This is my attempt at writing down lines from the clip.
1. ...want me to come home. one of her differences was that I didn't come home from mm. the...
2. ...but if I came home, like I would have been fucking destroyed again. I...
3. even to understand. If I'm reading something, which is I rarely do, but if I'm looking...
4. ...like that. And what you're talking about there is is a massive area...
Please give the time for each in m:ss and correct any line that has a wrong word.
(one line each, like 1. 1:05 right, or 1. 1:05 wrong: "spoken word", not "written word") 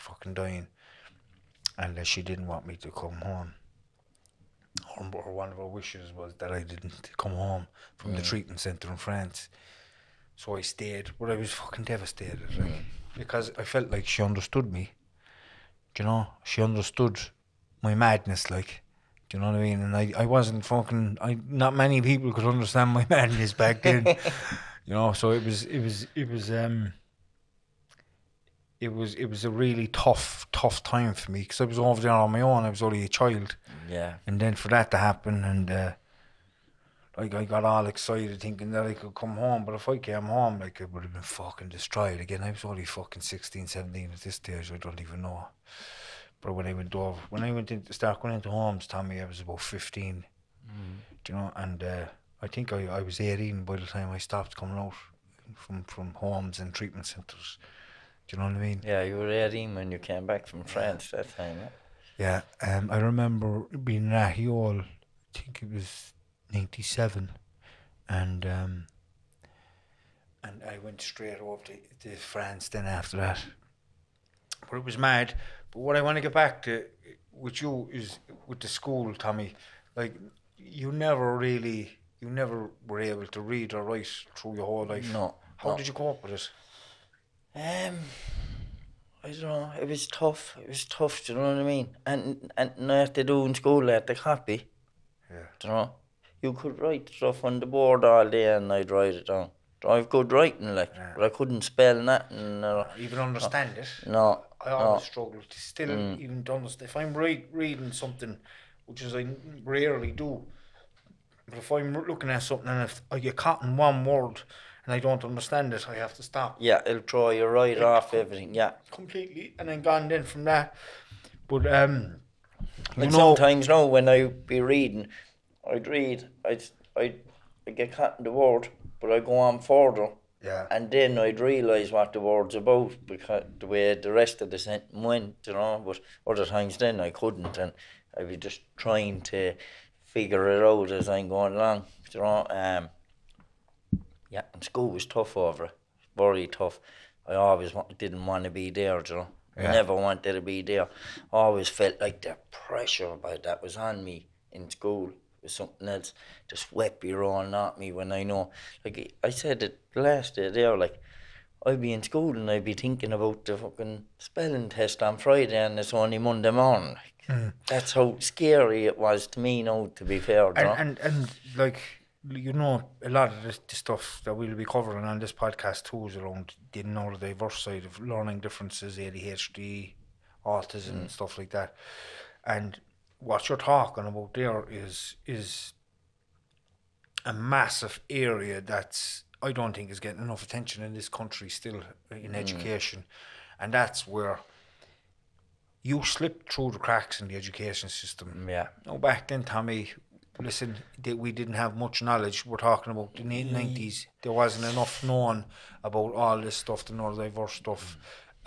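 1. 0:02 wrong: "wishes", not "differences"
2. 0:39 right
3. 1:46 right
4. 3:01 right.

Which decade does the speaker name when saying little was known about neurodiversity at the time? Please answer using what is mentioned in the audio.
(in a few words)
the nineties.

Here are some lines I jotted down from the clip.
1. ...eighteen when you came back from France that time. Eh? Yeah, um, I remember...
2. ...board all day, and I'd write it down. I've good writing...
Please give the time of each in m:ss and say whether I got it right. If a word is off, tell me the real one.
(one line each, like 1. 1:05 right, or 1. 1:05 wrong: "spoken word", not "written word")
1. 0:59 right
2. 1:37 right.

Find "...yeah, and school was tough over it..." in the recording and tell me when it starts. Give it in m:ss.
2:24.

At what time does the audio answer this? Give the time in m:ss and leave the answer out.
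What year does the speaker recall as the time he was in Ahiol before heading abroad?
1:06.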